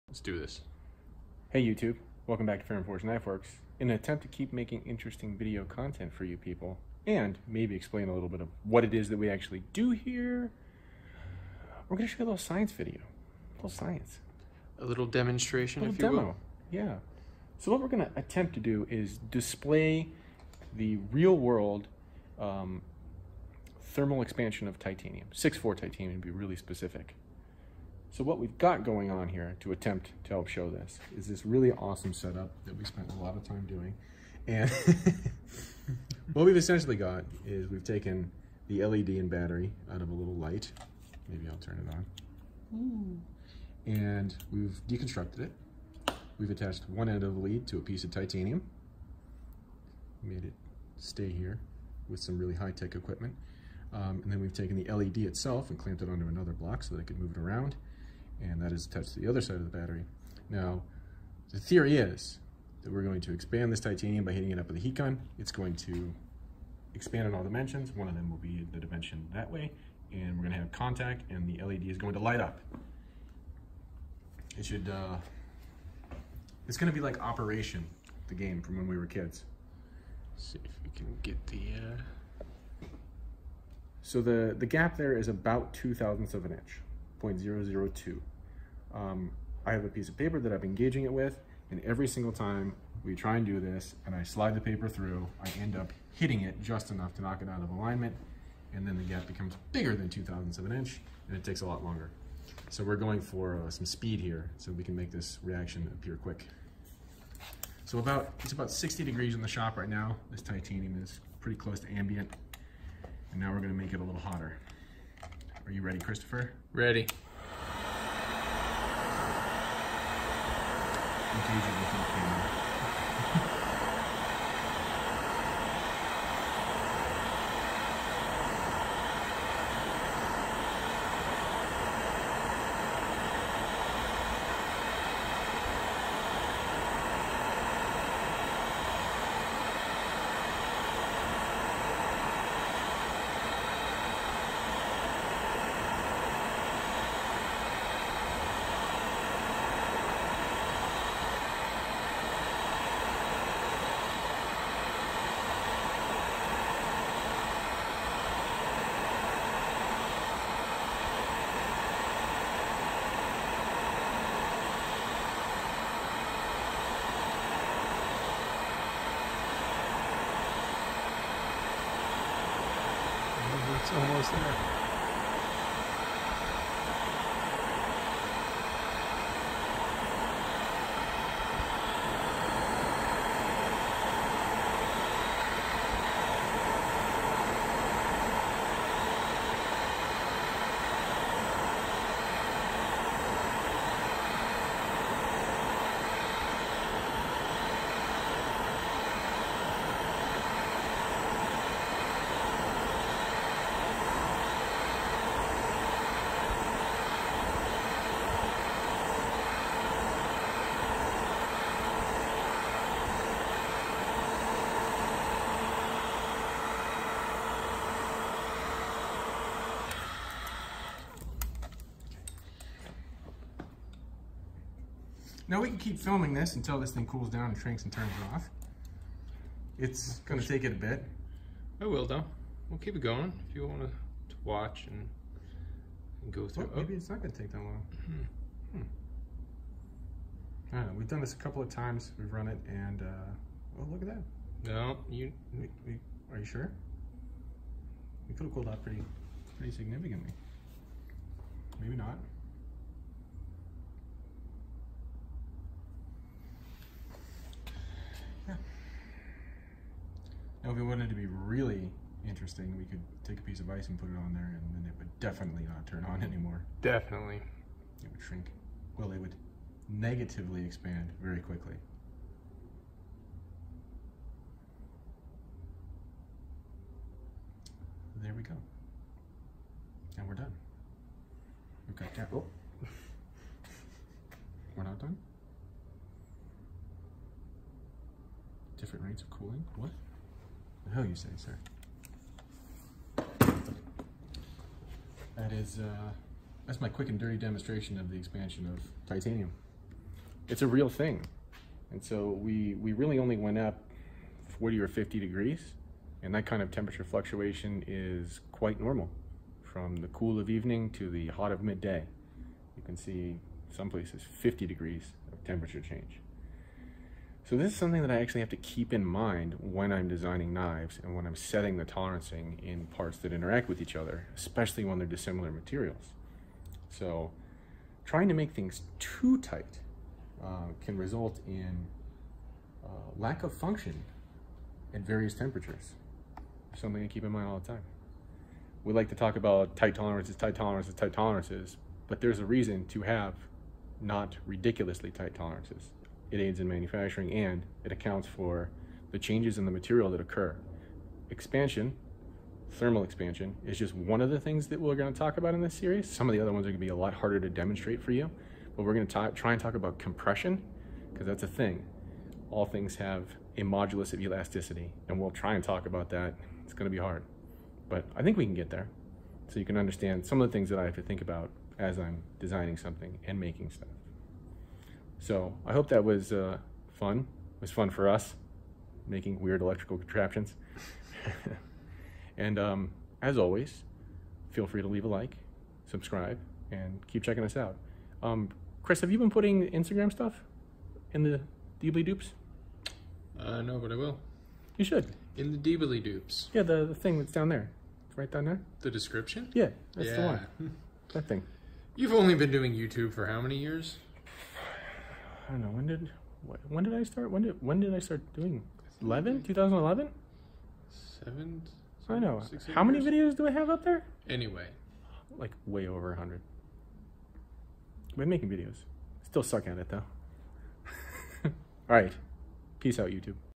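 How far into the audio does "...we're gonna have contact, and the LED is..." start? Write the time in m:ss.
1:10.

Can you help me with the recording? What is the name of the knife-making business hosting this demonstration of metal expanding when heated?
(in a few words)
Ferrum Forge Knifeworks.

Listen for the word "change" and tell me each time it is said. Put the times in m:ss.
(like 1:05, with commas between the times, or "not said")
5:15, 5:49.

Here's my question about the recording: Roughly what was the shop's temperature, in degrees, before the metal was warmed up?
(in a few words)
60 degrees.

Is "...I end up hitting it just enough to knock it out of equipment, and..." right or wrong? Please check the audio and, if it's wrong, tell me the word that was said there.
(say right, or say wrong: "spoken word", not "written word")
wrong: "alignment", not "equipment".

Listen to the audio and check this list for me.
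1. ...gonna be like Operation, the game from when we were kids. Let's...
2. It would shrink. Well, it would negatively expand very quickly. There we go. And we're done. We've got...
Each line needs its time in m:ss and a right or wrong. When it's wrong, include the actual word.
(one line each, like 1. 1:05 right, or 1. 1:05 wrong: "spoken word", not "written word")
1. 1:16 right
2. 4:28 right.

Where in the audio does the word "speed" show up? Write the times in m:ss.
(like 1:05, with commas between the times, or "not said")
1:43.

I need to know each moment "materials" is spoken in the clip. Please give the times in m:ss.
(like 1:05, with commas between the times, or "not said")
5:25, 5:49.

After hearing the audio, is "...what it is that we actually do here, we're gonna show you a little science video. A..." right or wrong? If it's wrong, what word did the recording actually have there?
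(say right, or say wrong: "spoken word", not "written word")
right.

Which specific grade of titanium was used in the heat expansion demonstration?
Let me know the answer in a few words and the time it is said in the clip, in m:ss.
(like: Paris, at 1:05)
6-4, at 0:25.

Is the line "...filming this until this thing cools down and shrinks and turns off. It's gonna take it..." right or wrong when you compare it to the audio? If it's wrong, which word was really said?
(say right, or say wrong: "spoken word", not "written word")
right.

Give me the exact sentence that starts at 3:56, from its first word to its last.
Oh, maybe it's not gonna take that long.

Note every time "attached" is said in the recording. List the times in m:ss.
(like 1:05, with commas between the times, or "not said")
0:46, 0:58.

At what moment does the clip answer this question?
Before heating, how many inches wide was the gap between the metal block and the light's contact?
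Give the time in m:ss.
1:27.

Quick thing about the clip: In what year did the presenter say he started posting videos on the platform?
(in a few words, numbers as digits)
2011.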